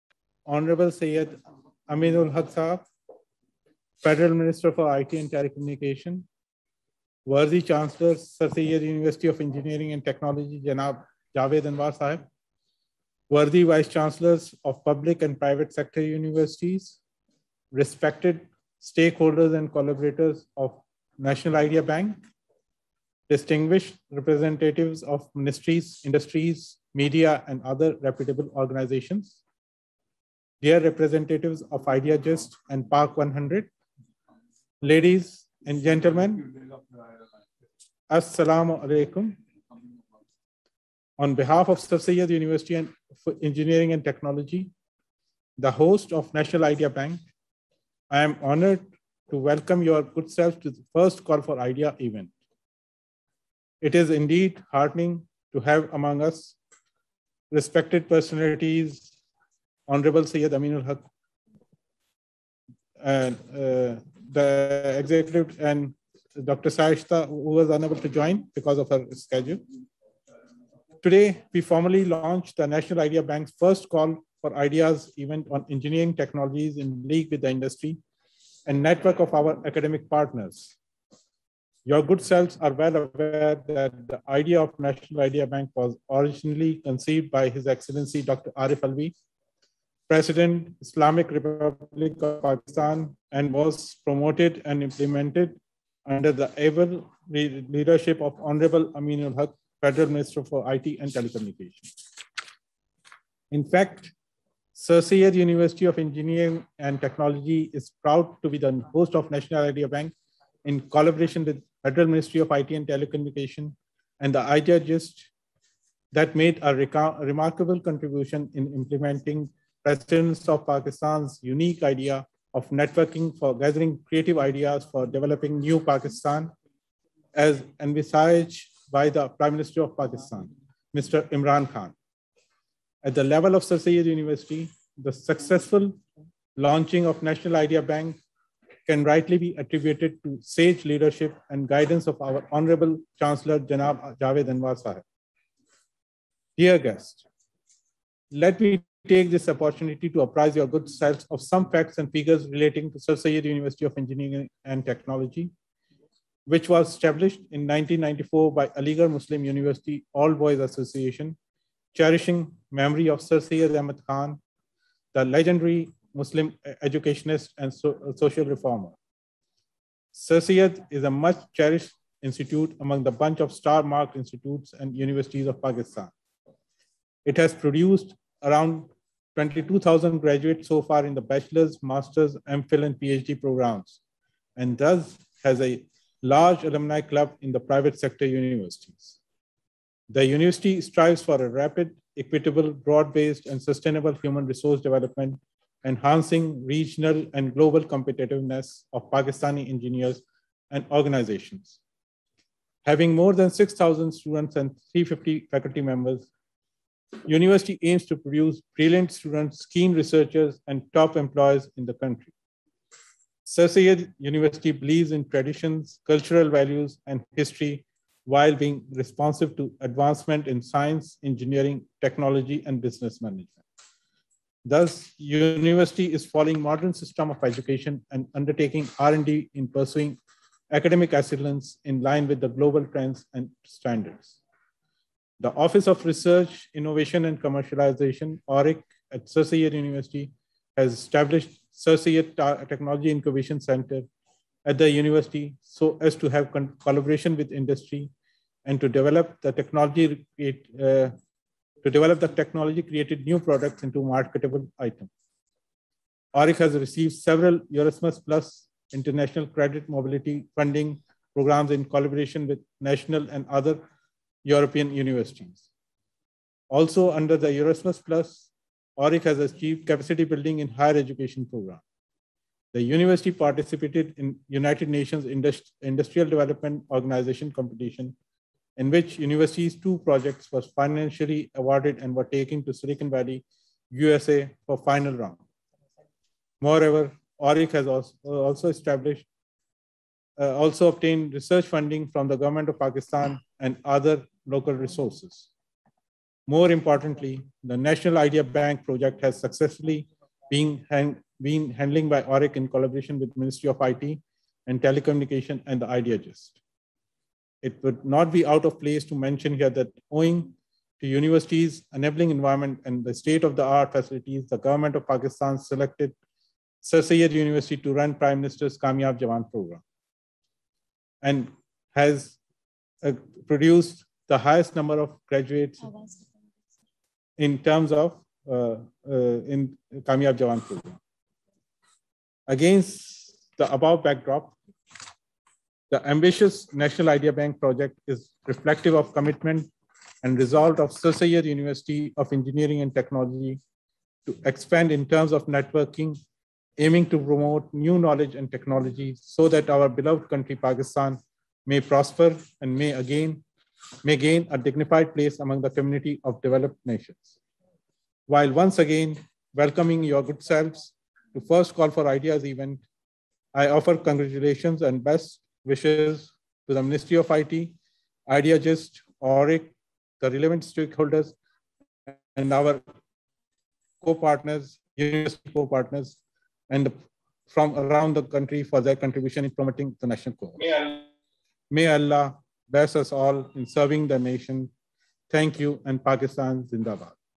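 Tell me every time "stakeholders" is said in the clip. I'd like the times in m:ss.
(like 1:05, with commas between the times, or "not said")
0:18, 6:10.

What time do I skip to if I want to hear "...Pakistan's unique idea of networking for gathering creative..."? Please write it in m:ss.
2:00.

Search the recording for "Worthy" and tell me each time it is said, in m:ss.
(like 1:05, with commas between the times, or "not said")
0:07, 0:13.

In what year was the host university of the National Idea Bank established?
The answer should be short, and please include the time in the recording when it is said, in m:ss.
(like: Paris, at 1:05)
1994, at 2:37.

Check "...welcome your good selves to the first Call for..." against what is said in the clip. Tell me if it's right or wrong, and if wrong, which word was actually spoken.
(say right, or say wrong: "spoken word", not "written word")
right.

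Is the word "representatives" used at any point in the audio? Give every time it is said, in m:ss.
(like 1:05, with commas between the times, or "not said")
0:24, 0:30.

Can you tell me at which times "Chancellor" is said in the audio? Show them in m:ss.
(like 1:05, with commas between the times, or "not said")
0:07, 0:13, 2:23.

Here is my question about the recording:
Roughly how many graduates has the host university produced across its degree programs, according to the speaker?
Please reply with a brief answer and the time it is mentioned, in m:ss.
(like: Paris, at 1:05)
22,000, at 2:59.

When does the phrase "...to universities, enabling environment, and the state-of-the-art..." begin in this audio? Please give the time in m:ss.
5:10.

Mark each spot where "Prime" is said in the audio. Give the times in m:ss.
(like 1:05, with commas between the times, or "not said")
2:09, 5:18.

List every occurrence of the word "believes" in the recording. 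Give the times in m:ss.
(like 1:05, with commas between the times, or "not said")
3:34.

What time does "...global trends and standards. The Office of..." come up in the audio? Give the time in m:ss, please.
3:52.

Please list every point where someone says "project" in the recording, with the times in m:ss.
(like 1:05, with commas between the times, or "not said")
4:39, 4:58, 5:37.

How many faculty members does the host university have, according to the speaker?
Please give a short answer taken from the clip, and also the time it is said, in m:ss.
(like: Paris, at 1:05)
350, at 3:24.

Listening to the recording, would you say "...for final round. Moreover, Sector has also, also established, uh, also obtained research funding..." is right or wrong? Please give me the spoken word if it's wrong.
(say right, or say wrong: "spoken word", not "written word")
wrong: "ORIC", not "Sector".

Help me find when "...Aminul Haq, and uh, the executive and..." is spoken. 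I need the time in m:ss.
1:00.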